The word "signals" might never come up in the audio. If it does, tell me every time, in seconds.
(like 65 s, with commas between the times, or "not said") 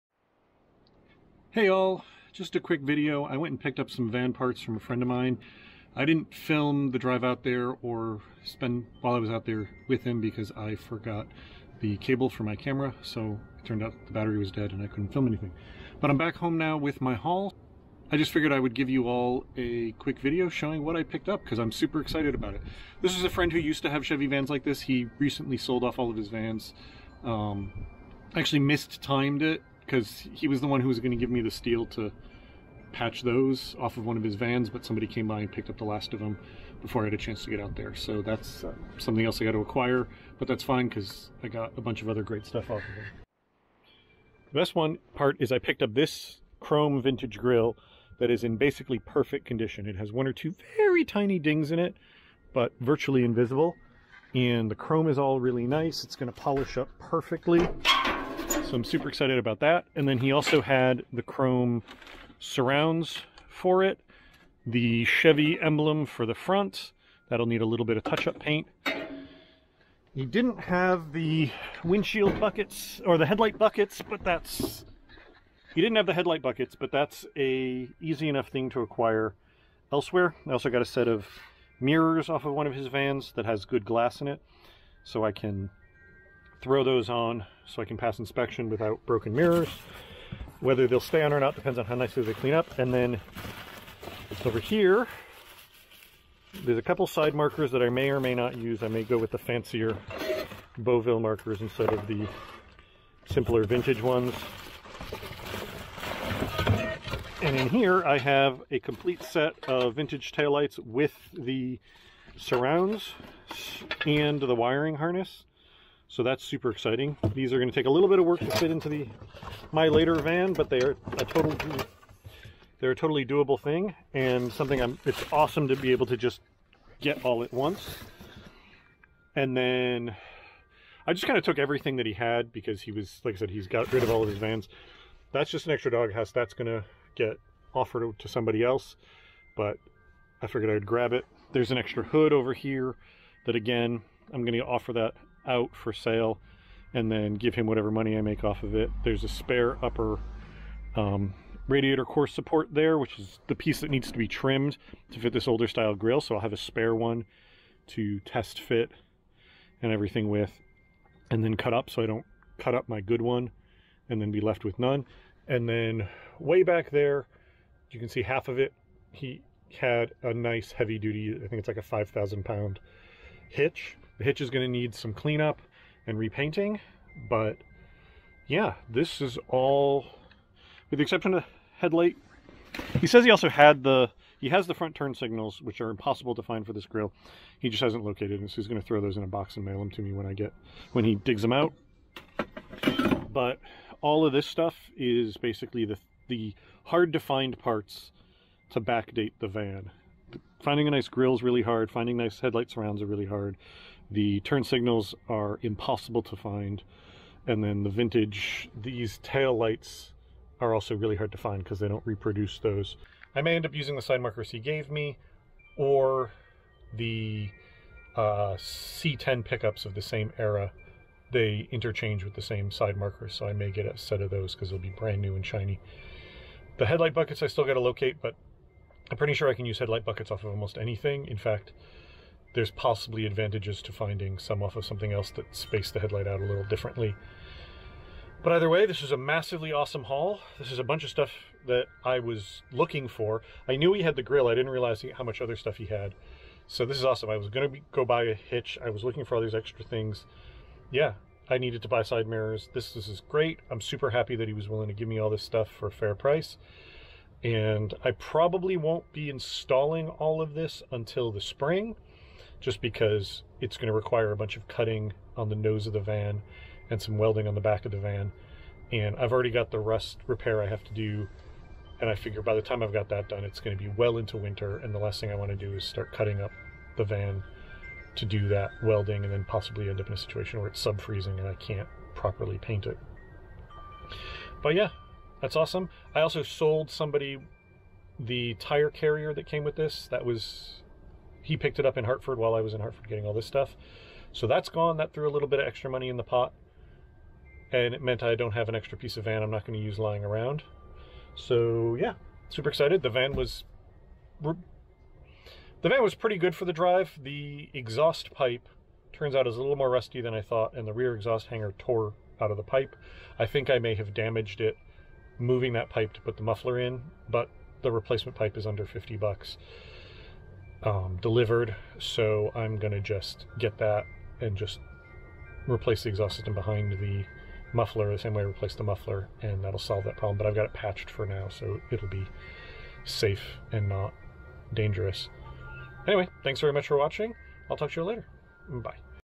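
185 s, 204 s.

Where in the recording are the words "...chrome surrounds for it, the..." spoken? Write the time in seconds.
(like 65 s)
61 s.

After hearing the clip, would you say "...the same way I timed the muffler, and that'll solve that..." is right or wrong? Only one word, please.
wrong.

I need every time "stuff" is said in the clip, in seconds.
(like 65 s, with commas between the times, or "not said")
42 s, 194 s, 241 s, 245 s, 255 s, 293 s.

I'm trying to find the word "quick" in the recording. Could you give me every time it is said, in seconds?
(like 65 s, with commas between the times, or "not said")
2 s, 19 s.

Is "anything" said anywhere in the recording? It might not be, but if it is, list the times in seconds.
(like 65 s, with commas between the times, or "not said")
15 s, 230 s.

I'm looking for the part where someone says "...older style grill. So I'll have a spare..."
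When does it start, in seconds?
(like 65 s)
155 s.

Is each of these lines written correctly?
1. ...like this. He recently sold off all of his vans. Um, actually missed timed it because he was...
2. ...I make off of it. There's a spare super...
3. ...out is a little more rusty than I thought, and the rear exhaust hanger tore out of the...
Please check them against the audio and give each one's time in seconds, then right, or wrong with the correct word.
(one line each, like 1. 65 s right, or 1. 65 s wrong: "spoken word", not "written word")
1. 24 s right
2. 148 s wrong: "upper", not "super"
3. 309 s right.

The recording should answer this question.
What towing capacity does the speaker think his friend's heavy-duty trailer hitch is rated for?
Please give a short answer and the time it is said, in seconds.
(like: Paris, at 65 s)
5,000 pounds, at 171 s.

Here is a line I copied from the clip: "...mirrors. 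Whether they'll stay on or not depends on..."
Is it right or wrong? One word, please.
right.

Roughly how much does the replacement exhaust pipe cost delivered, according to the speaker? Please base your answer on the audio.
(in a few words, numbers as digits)
under $50.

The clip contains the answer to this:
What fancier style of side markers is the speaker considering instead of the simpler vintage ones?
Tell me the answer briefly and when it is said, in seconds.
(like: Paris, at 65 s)
Beauville, at 100 s.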